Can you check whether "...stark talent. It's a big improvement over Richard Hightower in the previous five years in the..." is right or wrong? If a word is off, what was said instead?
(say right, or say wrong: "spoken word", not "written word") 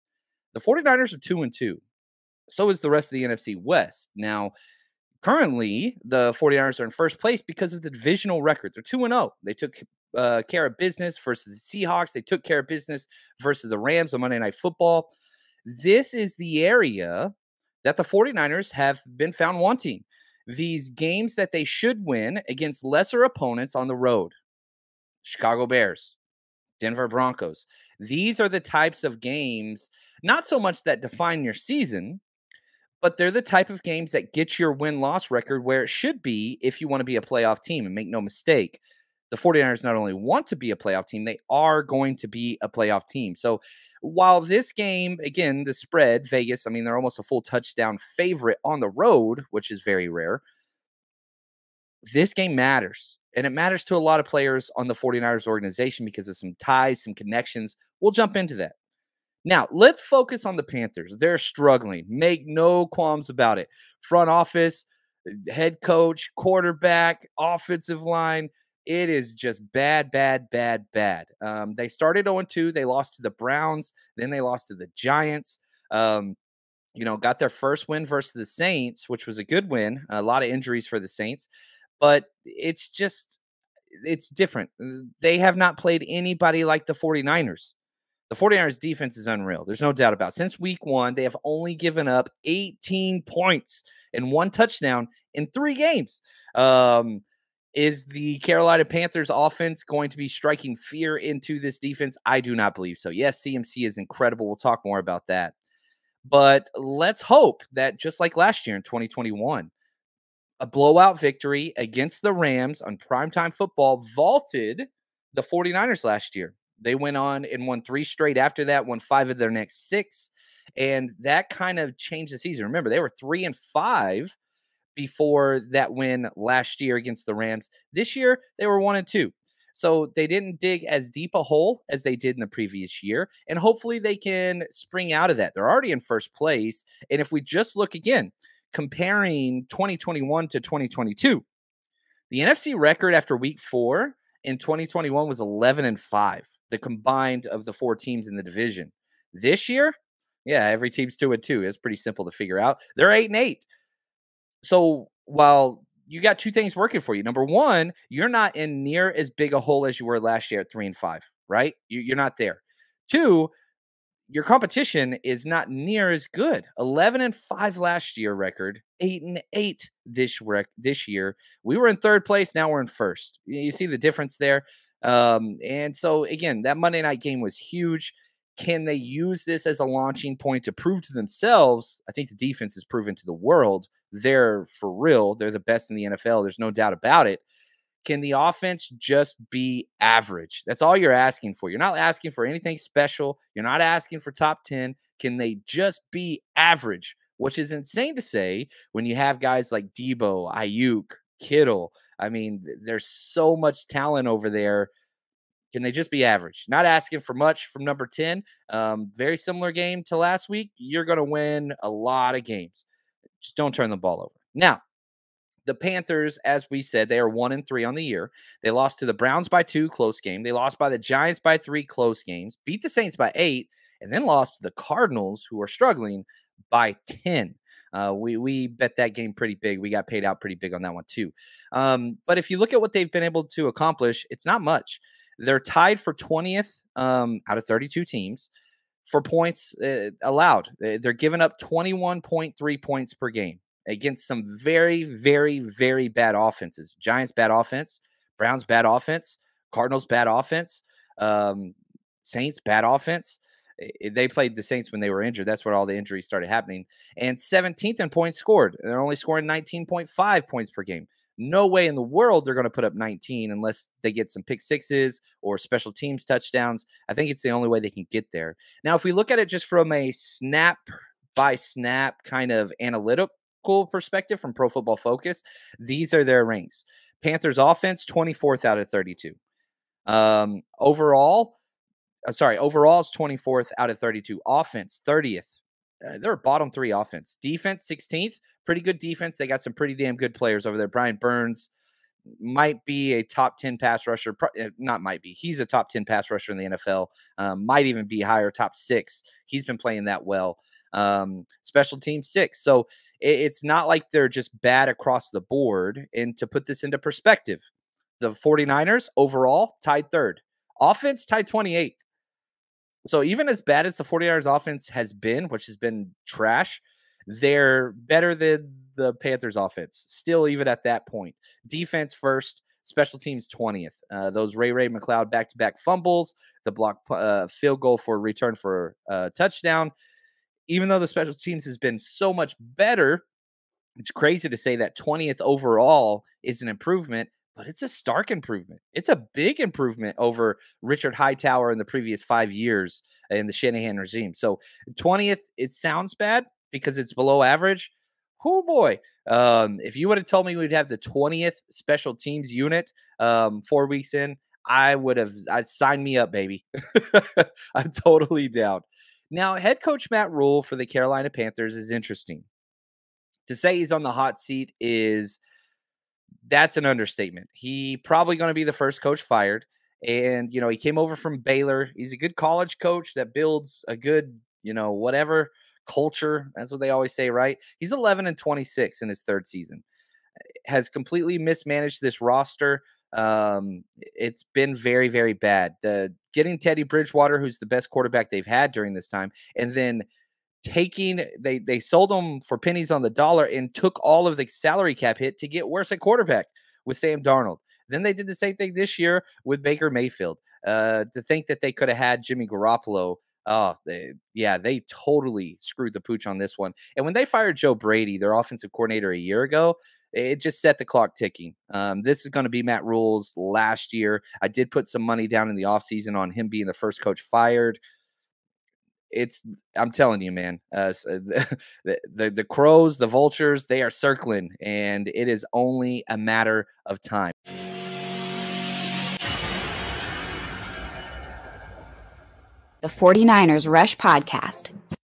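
wrong: "improvement", not "talent".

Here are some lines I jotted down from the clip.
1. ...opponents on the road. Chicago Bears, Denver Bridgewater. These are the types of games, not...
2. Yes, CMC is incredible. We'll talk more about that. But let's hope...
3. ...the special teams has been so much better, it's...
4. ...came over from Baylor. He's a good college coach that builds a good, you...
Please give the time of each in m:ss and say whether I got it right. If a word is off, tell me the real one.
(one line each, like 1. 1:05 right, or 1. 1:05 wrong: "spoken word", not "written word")
1. 0:23 wrong: "Broncos", not "Bridgewater"
2. 1:43 right
3. 5:30 right
4. 6:10 right.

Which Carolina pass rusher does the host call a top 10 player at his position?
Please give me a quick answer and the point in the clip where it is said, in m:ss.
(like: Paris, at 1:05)
Brian Burns, at 4:50.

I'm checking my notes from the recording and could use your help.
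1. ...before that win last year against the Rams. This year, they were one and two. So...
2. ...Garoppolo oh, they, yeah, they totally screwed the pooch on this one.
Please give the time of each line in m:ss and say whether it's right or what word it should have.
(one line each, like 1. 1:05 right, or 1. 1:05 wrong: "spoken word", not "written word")
1. 2:04 right
2. 6:42 right.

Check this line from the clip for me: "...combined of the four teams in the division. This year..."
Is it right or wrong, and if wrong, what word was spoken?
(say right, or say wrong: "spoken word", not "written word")
right.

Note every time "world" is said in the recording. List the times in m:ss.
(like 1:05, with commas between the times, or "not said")
3:03, 4:22.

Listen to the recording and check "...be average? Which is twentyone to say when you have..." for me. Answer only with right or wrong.
wrong.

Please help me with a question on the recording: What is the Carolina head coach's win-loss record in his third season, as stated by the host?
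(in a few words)
11 and 26.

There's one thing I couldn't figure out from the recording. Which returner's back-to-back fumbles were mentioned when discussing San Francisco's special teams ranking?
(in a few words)
Ray Ray McCloud.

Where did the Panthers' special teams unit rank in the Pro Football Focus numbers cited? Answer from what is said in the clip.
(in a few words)
6th.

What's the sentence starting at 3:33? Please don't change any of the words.
Just don't turn the ball over.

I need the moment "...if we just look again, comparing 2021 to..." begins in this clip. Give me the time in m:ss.
2:17.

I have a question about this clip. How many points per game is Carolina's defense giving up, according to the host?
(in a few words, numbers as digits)
21.3.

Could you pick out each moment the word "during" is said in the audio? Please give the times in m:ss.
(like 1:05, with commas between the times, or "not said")
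6:28.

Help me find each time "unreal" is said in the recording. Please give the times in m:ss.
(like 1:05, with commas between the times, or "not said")
1:29.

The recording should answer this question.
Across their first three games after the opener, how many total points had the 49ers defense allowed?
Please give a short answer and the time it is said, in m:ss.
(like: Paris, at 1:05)
18, at 1:32.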